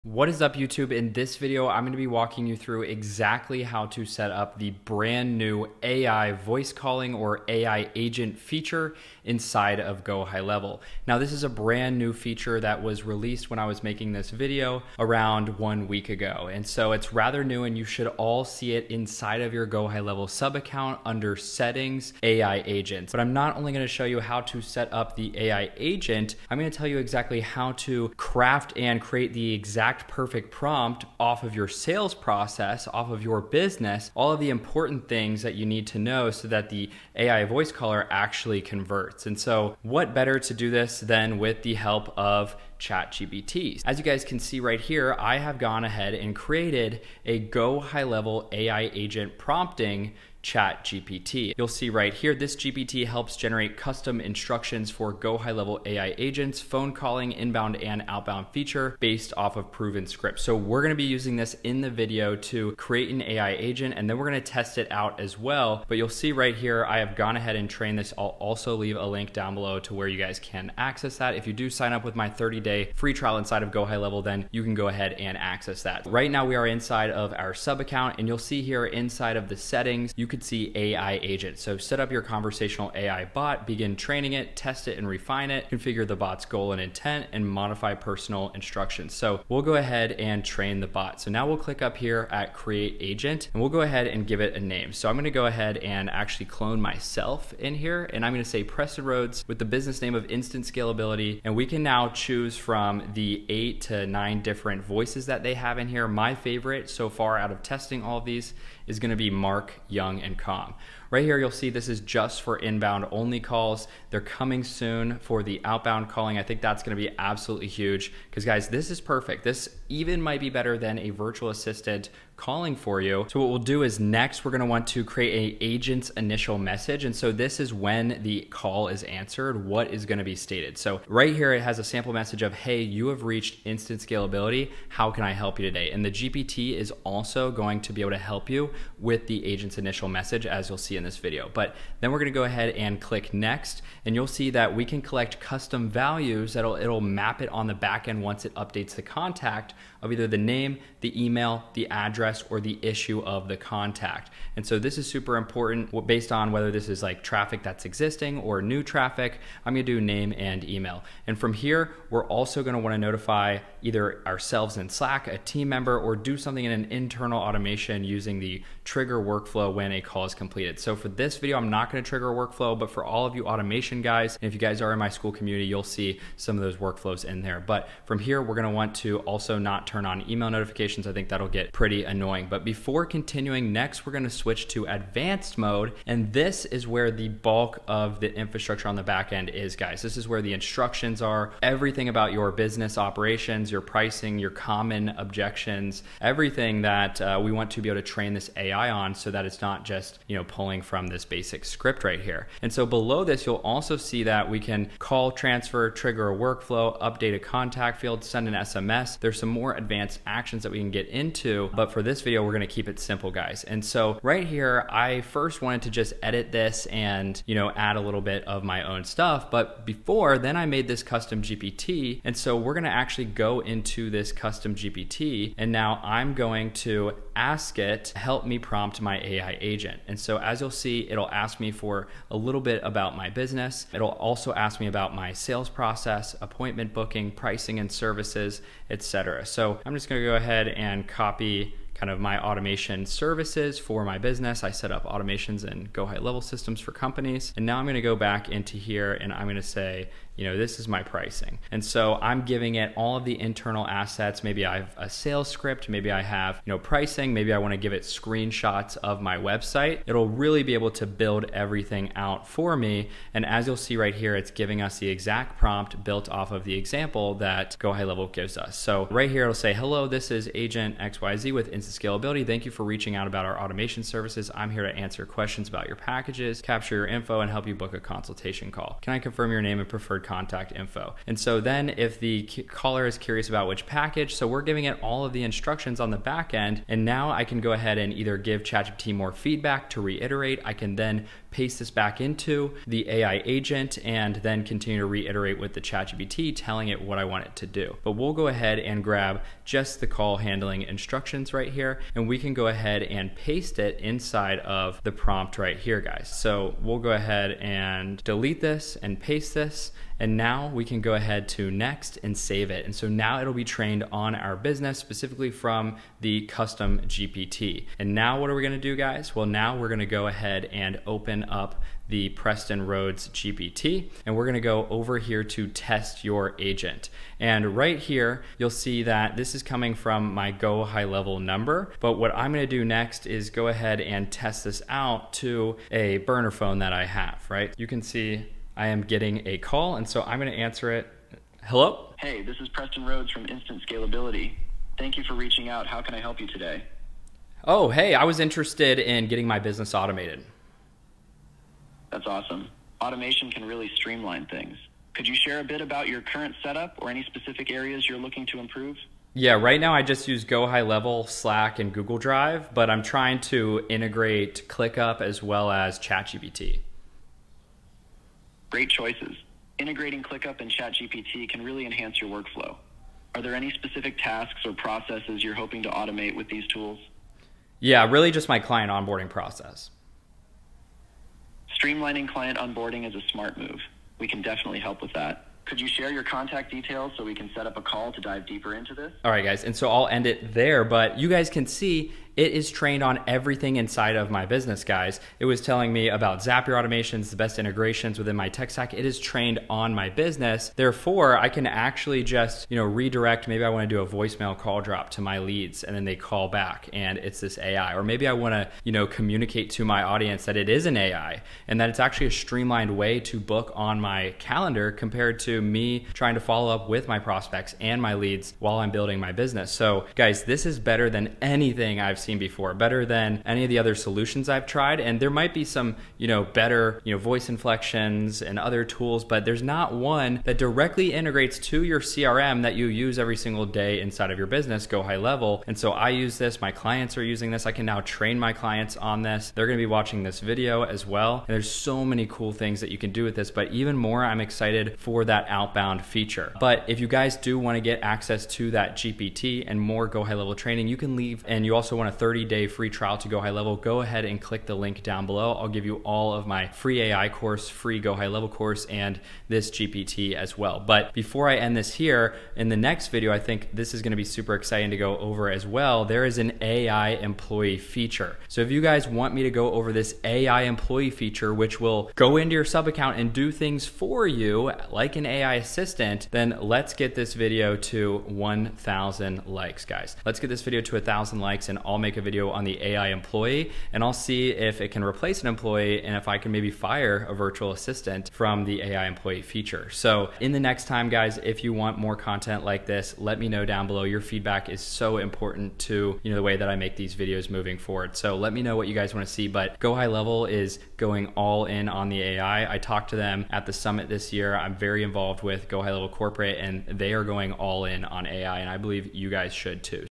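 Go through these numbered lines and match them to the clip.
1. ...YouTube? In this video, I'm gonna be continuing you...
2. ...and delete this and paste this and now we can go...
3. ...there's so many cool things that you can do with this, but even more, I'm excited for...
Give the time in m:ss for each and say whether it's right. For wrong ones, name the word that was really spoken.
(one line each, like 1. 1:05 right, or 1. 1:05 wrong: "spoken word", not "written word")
1. 0:00 wrong: "walking", not "continuing"
2. 5:07 right
3. 7:21 right.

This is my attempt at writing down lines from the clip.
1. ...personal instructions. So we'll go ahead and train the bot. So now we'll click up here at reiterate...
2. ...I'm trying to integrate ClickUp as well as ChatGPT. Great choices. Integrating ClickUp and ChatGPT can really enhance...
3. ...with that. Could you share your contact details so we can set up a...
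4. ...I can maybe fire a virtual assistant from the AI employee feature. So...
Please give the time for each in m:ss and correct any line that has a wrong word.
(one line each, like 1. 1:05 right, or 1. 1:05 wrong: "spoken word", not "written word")
1. 1:27 wrong: "create", not "reiterate"
2. 6:02 right
3. 6:25 right
4. 8:06 right.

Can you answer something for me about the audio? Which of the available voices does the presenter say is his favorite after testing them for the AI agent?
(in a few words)
Mark.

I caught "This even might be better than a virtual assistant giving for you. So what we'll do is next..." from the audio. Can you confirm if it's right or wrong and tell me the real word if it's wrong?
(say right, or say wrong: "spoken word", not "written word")
wrong: "calling", not "giving".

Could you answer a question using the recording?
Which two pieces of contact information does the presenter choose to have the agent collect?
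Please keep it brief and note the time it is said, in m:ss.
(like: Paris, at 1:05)
Name and email, at 2:40.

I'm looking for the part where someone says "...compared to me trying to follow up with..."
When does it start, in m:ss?
6:54.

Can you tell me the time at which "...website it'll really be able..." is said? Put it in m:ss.
4:19.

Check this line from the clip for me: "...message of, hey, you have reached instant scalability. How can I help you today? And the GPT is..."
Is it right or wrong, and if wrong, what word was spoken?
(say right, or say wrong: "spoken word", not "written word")
right.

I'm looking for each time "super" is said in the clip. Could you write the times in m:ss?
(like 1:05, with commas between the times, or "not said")
2:35, 7:44.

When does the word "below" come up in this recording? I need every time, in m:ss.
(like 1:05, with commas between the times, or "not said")
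1:09, 3:22, 7:35, 8:13.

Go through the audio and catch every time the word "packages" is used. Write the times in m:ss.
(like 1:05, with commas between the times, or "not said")
4:35, 4:43.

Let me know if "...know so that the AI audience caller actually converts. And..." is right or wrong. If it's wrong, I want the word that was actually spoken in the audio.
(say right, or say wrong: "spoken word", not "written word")
wrong: "voice", not "audience".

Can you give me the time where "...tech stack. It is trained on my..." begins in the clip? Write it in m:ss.
6:38.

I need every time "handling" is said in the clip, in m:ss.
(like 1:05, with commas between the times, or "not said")
5:00.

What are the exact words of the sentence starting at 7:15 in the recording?
And so I use this, my clients are using this.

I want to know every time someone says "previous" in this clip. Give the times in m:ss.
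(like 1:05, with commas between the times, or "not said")
not said.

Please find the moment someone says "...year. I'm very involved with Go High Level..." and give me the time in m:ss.
8:24.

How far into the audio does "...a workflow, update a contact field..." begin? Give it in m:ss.
3:26.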